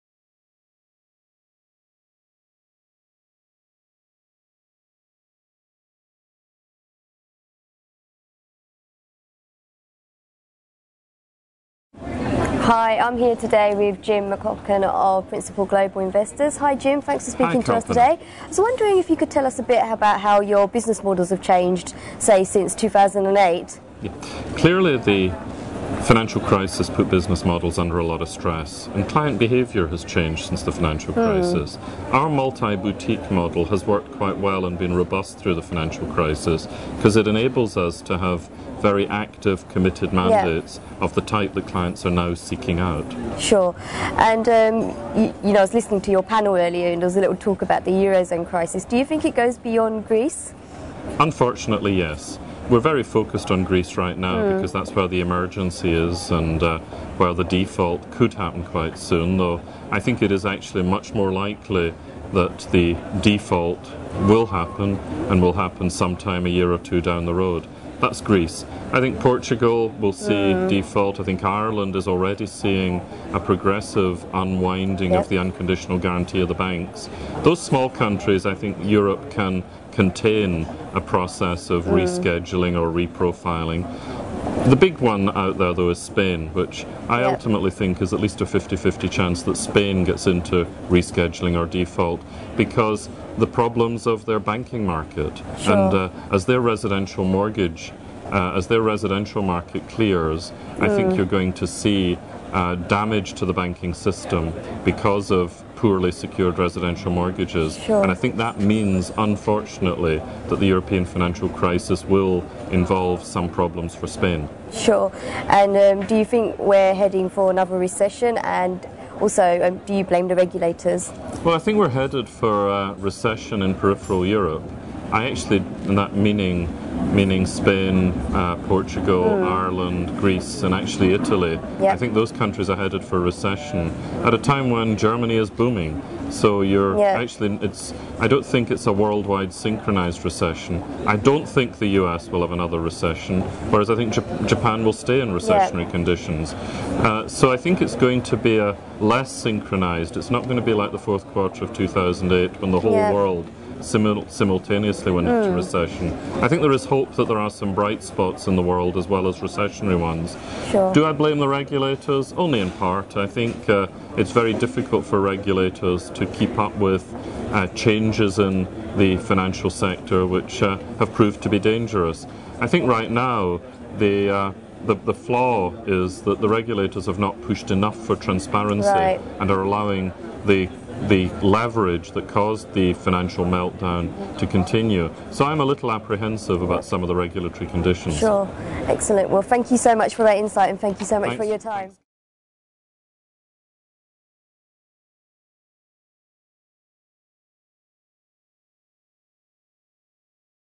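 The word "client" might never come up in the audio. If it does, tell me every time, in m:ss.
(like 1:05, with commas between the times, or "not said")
0:29, 0:41.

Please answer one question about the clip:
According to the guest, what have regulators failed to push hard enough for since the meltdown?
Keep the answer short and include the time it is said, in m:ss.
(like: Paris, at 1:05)
transparency, at 2:58.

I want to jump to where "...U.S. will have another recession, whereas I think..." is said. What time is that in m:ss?
2:22.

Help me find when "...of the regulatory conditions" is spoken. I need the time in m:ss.
3:07.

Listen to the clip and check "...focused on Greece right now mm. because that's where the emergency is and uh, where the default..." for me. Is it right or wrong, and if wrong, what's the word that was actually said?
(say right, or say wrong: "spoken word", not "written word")
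right.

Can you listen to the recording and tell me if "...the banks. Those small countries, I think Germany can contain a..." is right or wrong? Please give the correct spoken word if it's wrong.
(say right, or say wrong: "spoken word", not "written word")
wrong: "Europe", not "Germany".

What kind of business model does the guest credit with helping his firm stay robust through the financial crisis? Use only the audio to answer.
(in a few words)
multi boutique model.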